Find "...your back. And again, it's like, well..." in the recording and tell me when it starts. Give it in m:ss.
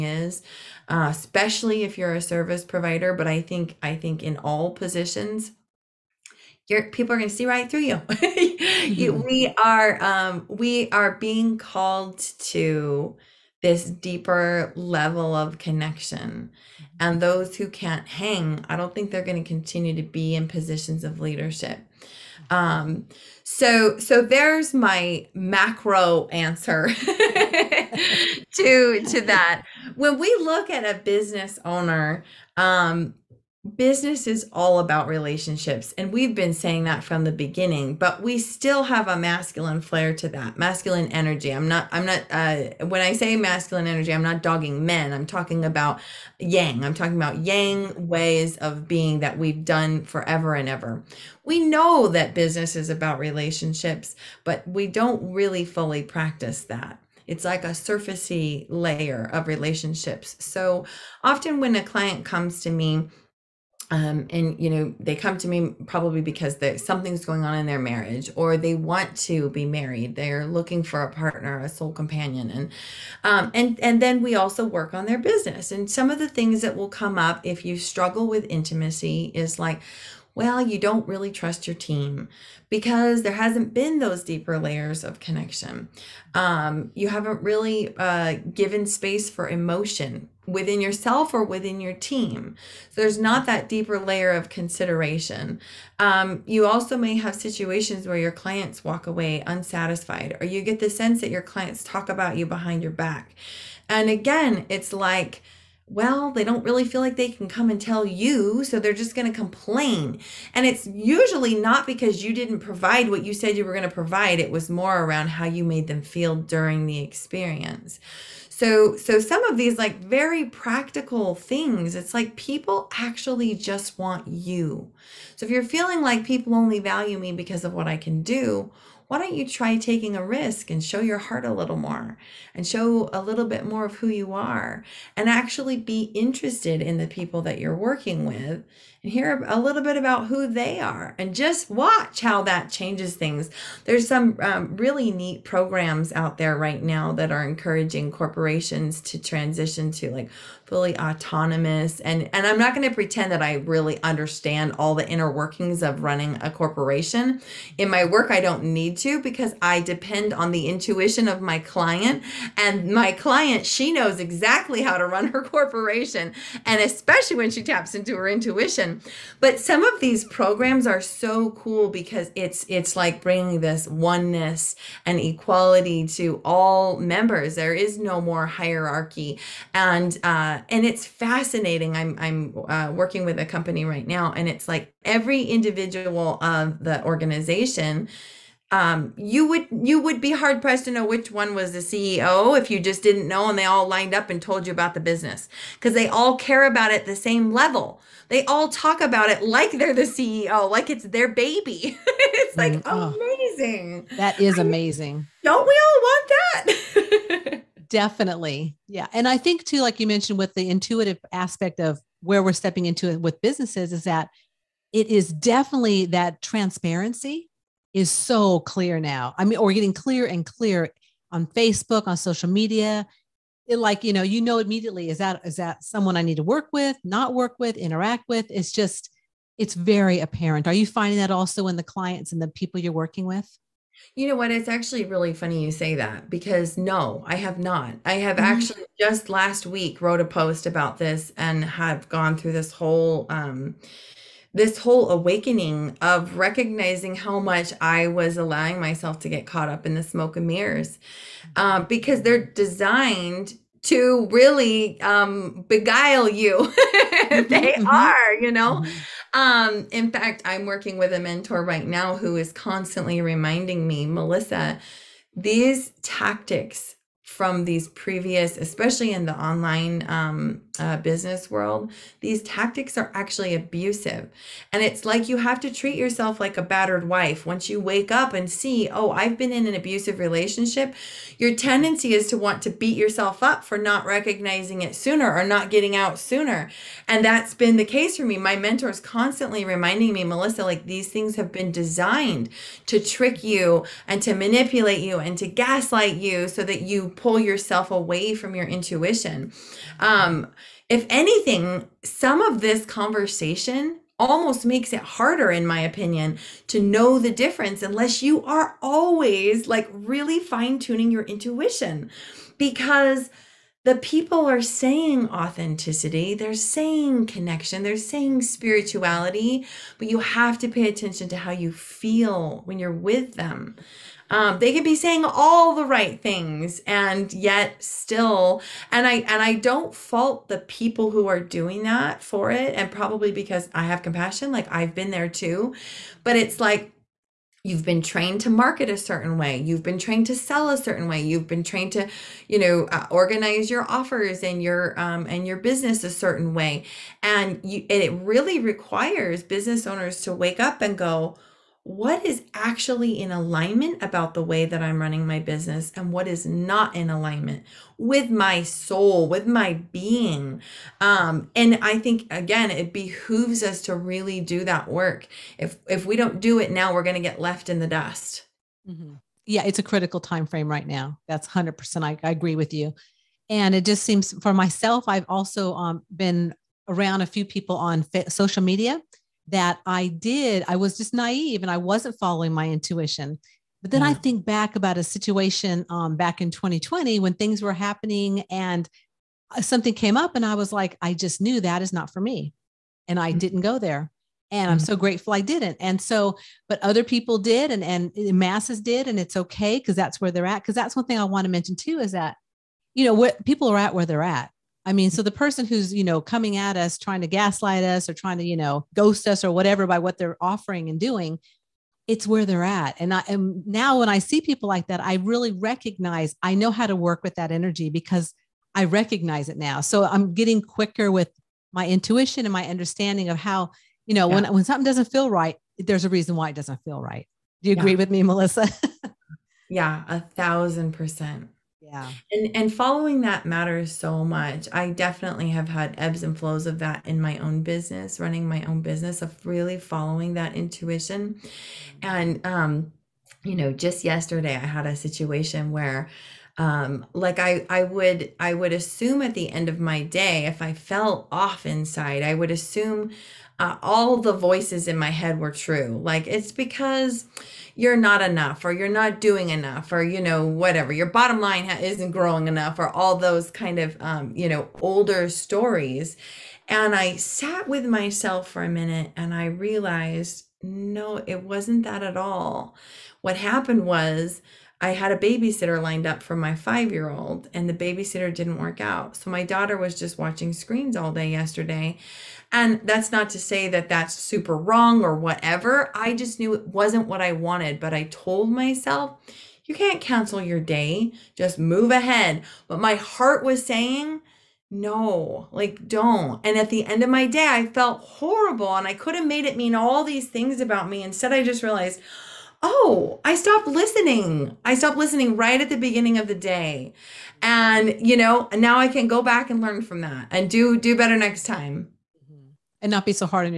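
1:42.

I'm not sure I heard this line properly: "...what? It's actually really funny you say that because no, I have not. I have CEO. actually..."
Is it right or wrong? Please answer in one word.
wrong.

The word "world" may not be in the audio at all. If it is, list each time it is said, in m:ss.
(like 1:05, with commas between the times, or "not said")
4:31.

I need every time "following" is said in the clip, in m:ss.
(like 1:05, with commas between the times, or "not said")
6:22, 7:12, 7:19.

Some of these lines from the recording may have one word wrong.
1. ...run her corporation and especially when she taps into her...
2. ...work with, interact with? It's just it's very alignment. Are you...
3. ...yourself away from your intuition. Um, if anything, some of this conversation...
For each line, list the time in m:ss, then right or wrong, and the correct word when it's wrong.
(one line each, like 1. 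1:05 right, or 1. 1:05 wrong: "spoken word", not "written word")
1. 2:45 right
2. 3:47 wrong: "apparent", not "alignment"
3. 4:57 right.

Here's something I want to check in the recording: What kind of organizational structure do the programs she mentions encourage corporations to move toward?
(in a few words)
fully autonomous.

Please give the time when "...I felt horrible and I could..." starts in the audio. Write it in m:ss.
8:17.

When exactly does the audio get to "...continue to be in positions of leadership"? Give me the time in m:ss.
0:19.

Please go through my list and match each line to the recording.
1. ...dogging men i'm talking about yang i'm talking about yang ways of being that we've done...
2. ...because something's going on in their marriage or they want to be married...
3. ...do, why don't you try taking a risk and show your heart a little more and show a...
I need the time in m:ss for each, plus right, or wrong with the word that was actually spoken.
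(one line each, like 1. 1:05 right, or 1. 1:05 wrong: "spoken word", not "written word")
1. 0:44 right
2. 1:06 right
3. 2:08 right.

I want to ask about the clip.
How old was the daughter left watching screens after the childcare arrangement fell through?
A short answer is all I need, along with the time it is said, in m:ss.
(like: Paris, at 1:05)
5, at 7:56.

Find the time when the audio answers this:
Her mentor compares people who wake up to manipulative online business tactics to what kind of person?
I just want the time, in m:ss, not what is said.
4:36.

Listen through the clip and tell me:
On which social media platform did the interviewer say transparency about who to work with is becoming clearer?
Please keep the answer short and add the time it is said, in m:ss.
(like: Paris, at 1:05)
Facebook, at 3:41.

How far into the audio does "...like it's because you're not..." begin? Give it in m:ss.
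7:36.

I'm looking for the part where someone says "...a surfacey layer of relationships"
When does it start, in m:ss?
0:57.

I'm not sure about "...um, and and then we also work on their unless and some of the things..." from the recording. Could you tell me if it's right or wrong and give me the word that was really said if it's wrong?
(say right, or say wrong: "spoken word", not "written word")
wrong: "business", not "unless".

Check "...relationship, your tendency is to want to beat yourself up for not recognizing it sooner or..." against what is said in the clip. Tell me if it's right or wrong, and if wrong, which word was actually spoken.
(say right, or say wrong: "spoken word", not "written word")
right.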